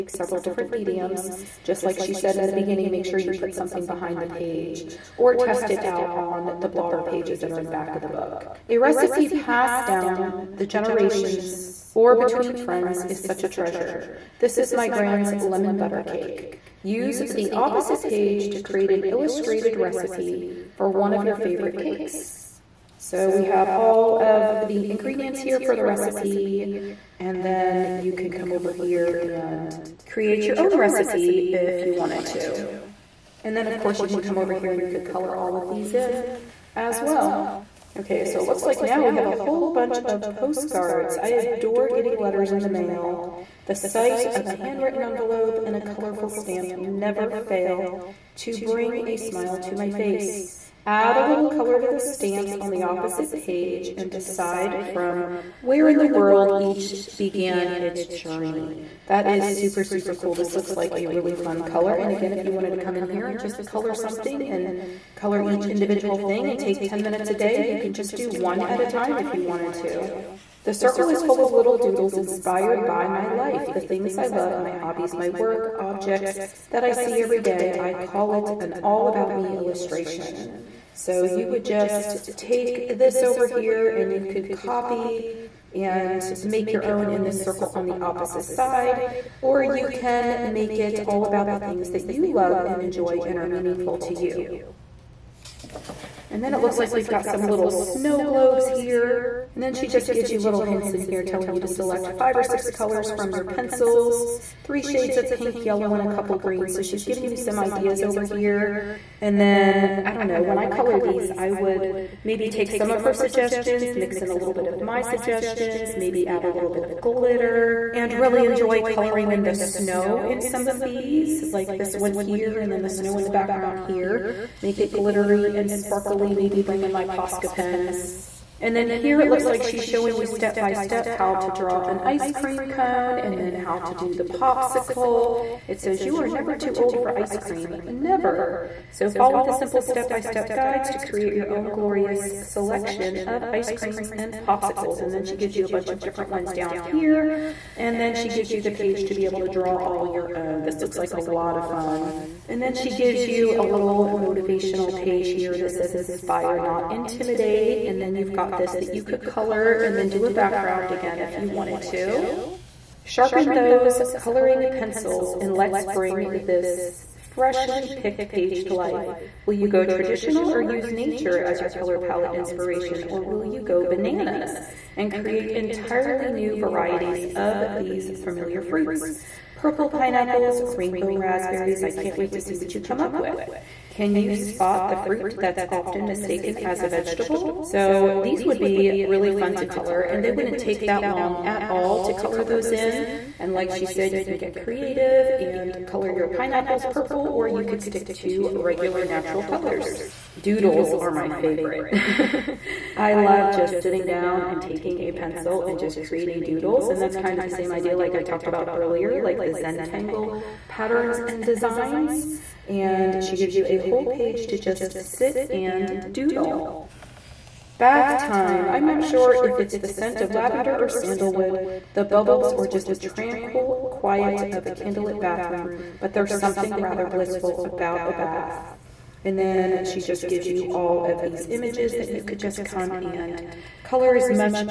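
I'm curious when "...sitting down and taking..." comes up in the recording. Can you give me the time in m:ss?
3:23.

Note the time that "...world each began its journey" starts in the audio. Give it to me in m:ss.
0:56.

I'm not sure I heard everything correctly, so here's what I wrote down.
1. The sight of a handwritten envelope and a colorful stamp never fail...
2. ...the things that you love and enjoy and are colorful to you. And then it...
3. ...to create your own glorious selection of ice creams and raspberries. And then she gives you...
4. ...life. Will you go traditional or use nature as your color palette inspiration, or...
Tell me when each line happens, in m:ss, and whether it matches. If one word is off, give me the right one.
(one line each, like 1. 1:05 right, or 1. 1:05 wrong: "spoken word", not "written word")
1. 0:43 right
2. 1:31 wrong: "meaningful", not "colorful"
3. 2:20 wrong: "popsicles", not "raspberries"
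4. 2:48 right.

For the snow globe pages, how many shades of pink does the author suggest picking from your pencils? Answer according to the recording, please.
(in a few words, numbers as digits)
3.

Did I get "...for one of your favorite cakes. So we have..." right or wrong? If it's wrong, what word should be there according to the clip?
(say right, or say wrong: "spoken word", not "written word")
right.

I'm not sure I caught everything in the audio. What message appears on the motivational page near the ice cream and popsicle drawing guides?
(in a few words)
Inspire, not intimidate.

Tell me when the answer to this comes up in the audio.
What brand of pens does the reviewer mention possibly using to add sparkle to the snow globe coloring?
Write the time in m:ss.
2:07.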